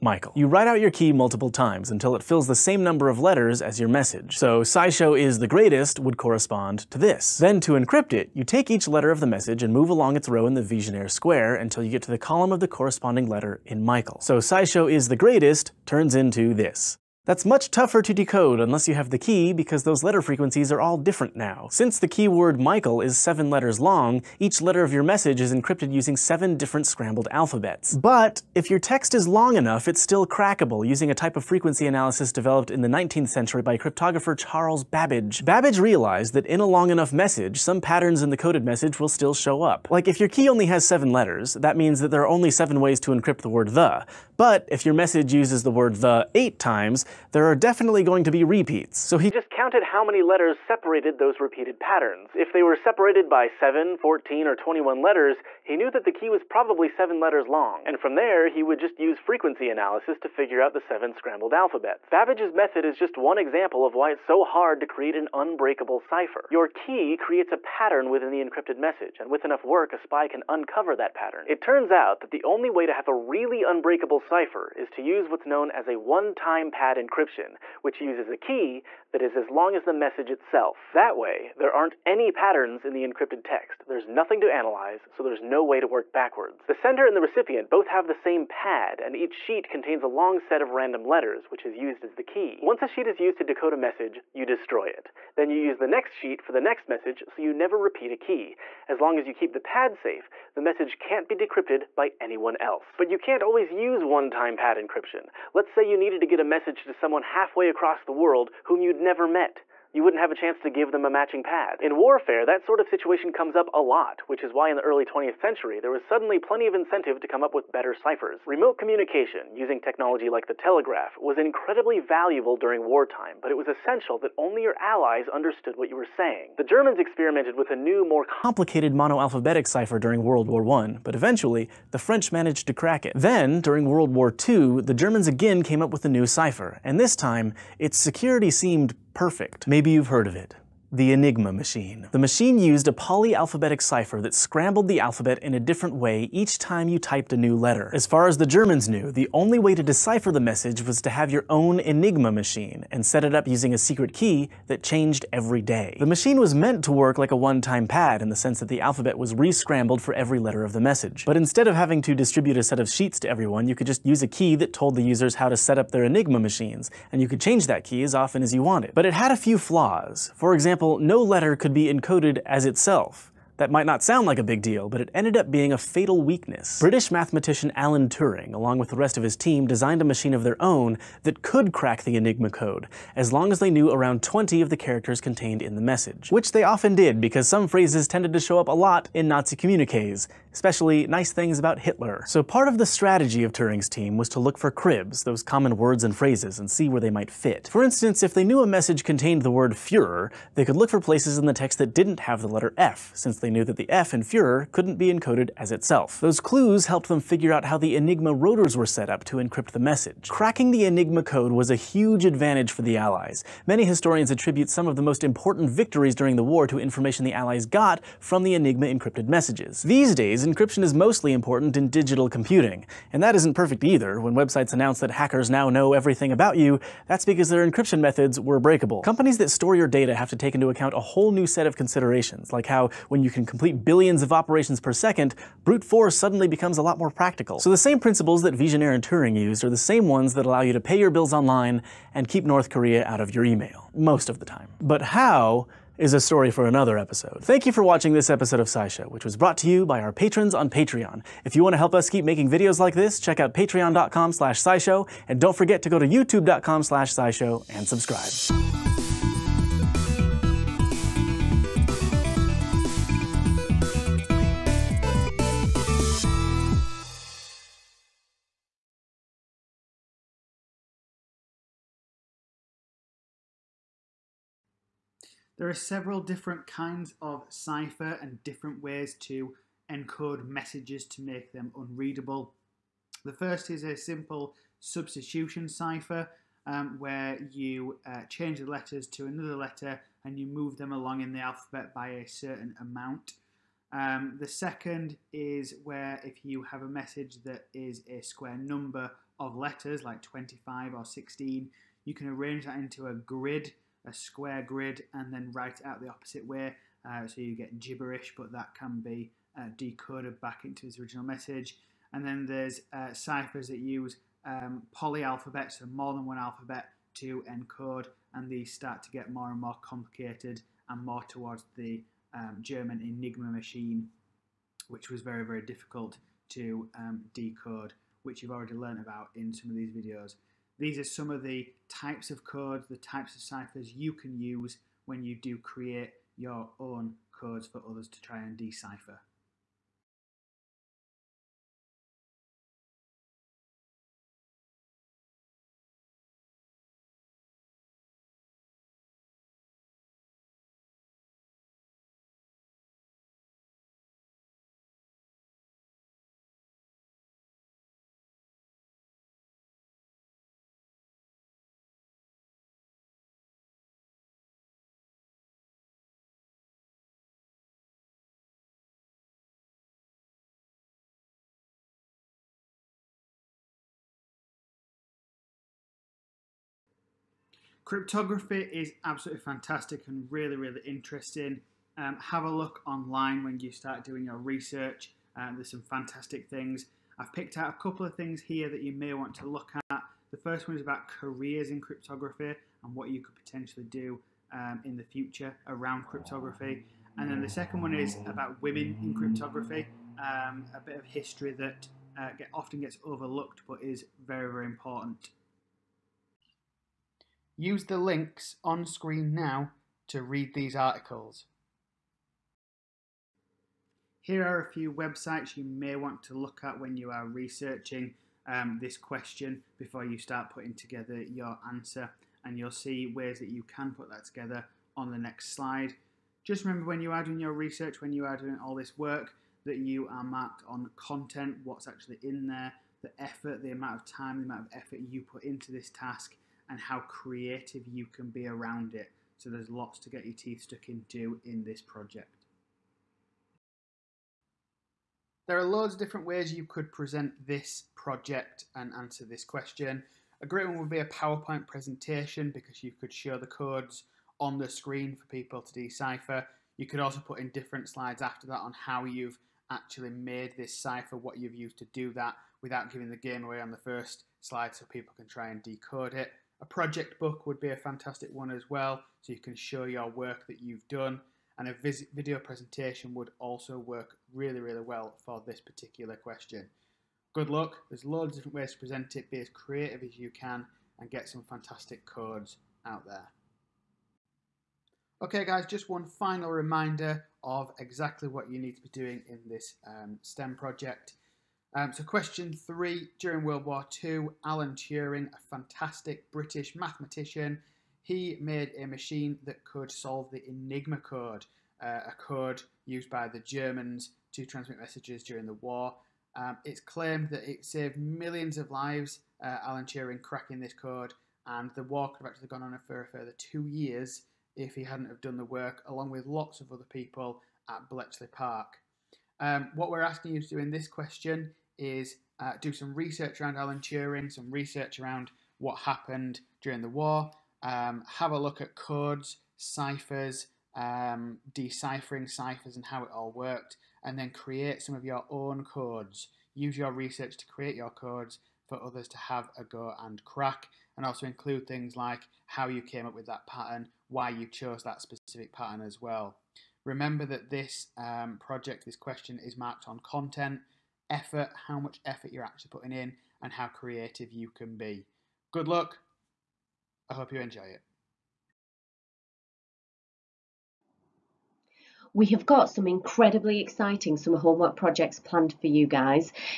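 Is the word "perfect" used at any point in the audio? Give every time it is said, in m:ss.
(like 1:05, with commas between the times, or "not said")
2:19, 3:43.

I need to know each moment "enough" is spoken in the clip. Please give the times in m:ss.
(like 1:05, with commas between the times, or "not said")
0:29, 0:36, 1:09.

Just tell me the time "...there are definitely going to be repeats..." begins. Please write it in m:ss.
0:47.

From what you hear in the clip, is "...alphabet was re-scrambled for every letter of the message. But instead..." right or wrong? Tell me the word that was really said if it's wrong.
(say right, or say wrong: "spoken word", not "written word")
right.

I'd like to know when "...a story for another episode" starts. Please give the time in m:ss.
4:06.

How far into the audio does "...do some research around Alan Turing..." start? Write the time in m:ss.
8:42.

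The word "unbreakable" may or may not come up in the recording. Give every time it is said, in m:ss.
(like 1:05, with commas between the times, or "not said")
1:05, 1:13.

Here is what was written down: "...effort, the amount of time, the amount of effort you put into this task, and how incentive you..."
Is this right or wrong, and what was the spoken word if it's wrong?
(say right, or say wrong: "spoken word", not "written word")
wrong: "creative", not "incentive".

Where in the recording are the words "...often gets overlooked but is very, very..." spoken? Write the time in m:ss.
6:42.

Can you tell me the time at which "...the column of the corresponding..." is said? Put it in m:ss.
0:12.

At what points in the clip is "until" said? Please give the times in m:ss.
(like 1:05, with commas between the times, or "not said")
0:01, 0:11.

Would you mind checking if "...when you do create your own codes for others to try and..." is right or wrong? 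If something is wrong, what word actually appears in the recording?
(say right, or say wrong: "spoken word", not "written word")
right.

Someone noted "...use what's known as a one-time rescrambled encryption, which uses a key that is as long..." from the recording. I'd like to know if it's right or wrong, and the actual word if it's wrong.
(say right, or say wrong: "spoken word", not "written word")
wrong: "padded", not "rescrambled".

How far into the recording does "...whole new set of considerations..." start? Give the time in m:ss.
3:50.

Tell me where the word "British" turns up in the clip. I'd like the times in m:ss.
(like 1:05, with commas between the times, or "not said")
2:56, 8:16.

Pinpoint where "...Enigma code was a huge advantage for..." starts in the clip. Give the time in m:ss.
3:30.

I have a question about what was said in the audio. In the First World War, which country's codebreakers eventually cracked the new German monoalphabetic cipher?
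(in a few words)
French.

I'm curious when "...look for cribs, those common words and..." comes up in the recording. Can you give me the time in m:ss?
3:14.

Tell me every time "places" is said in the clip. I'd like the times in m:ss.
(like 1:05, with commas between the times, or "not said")
3:20.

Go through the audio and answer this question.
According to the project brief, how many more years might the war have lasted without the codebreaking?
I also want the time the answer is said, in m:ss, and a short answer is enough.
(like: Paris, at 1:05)
2, at 8:33.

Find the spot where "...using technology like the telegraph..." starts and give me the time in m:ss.
1:59.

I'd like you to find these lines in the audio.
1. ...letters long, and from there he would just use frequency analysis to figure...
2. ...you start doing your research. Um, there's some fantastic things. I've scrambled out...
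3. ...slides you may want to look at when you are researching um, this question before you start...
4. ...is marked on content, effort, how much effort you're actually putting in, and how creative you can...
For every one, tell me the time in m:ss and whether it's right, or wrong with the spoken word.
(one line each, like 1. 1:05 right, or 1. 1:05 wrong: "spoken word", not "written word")
1. 0:57 right
2. 6:23 wrong: "picked", not "scrambled"
3. 6:54 wrong: "websites", not "slides"
4. 9:09 right.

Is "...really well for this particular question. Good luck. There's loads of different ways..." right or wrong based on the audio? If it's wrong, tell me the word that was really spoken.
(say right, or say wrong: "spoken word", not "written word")
right.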